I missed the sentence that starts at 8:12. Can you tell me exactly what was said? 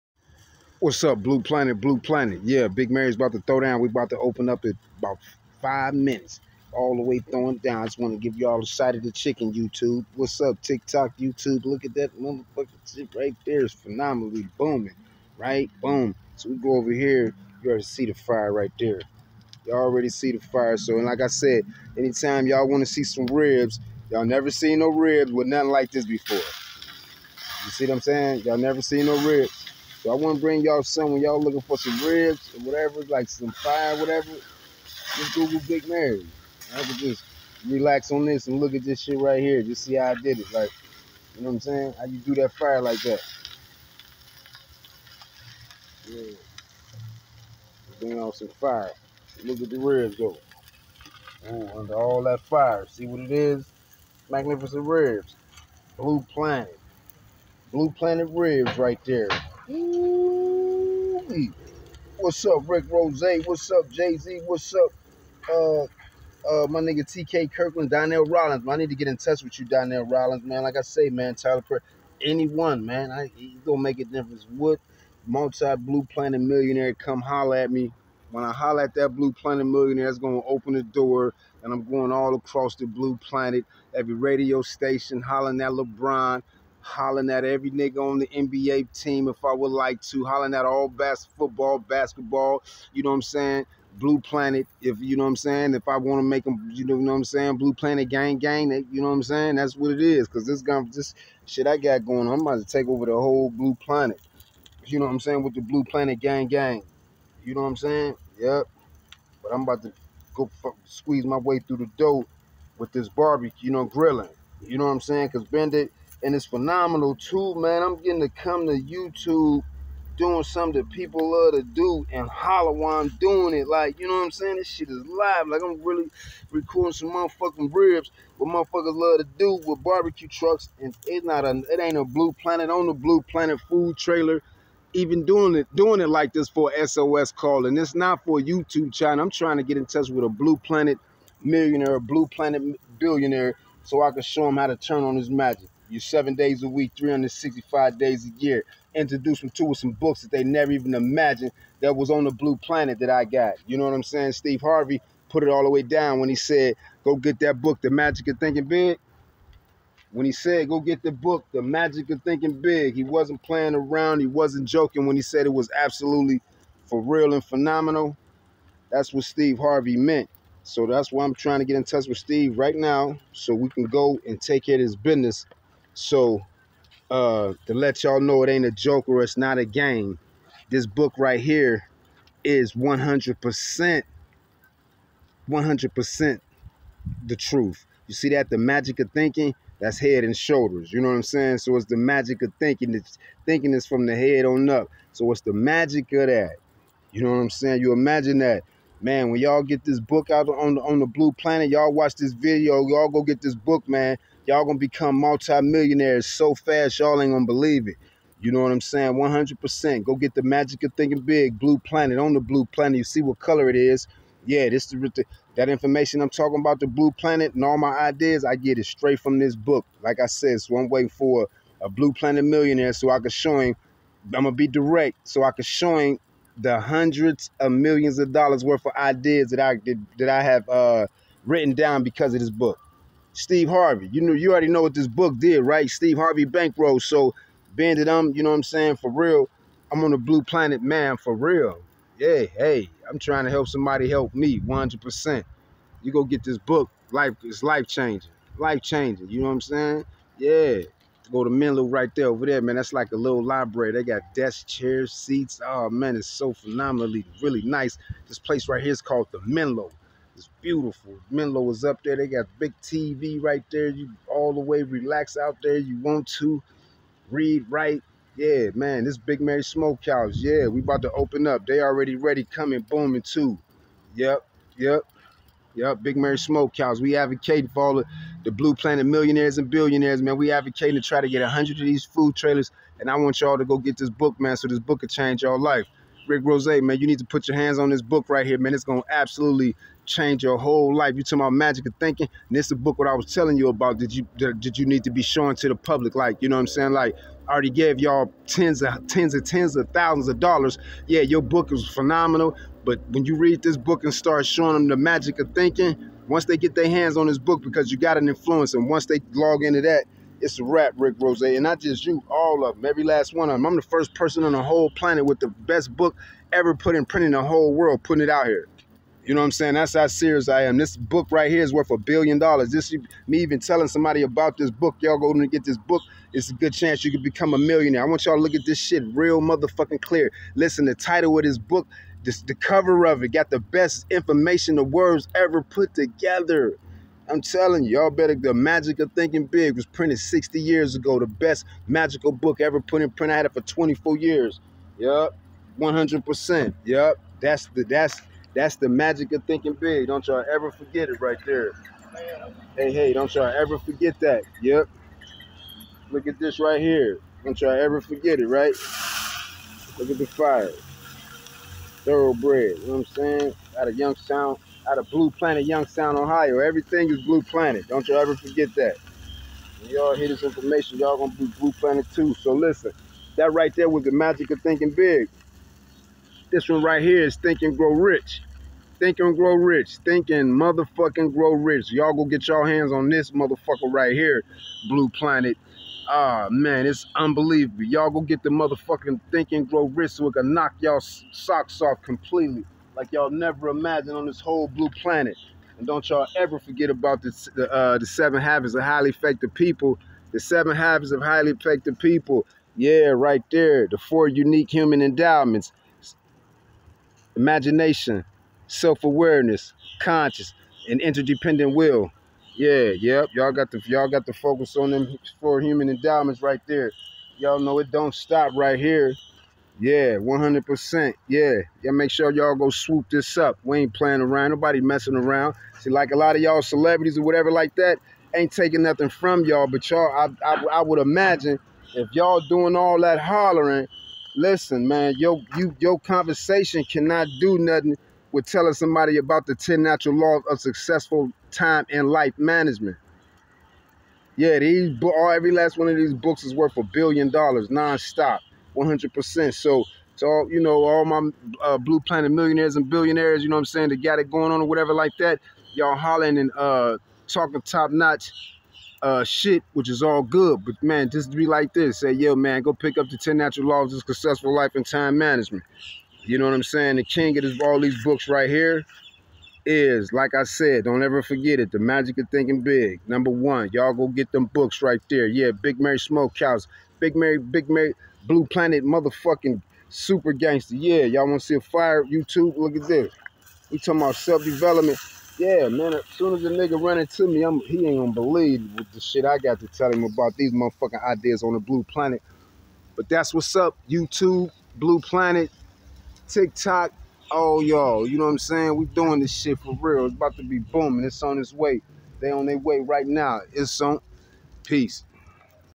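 But that's what's up, YouTube, Blue Planet, TikTok, all y'all.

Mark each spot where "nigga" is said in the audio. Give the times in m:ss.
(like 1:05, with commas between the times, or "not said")
1:06, 1:27, 8:06.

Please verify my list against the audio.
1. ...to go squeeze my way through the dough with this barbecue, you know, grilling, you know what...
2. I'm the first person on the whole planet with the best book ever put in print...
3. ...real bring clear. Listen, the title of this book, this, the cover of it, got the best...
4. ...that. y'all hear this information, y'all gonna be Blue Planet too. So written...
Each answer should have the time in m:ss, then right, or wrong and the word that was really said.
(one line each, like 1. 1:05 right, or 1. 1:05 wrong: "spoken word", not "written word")
1. 1:49 right
2. 5:13 right
3. 5:29 wrong: "motherfucking", not "bring"
4. 6:08 wrong: "listen", not "written".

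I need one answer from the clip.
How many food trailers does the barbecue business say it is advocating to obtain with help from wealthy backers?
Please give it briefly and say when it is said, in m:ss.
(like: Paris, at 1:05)
100, at 4:41.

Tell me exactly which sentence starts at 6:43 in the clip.
The four unique human endowments imagination, self awareness, conscious, and interdependent will.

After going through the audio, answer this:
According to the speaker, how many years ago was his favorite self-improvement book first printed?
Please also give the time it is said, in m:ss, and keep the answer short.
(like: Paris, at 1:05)
60, at 5:39.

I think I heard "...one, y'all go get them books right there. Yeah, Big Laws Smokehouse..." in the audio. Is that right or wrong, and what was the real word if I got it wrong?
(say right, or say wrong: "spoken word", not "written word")
wrong: "Mary", not "Laws".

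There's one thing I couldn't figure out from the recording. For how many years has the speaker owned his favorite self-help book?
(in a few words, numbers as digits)
24.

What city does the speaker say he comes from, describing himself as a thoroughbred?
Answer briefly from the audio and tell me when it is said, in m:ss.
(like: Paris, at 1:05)
Youngstown, Ohio, at 6:05.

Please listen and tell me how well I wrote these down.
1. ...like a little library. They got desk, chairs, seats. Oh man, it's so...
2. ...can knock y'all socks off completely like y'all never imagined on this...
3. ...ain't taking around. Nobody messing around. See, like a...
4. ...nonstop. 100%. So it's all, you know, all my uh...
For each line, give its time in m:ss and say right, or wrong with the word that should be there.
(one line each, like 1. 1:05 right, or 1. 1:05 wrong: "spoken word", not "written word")
1. 4:12 right
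2. 6:30 right
3. 7:03 wrong: "playing", not "taking"
4. 7:27 right.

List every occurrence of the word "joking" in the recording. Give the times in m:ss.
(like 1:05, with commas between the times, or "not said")
2:44.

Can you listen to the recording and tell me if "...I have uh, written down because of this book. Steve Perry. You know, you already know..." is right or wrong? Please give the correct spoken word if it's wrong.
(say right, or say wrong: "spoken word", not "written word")
wrong: "Harvey", not "Perry".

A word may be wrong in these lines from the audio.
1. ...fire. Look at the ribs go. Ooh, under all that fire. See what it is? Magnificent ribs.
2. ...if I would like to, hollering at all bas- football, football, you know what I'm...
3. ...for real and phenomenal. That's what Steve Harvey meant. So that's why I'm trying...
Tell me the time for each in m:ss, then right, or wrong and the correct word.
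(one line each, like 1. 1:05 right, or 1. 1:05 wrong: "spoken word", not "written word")
1. 0:48 right
2. 1:29 wrong: "basketball", not "football"
3. 2:46 right.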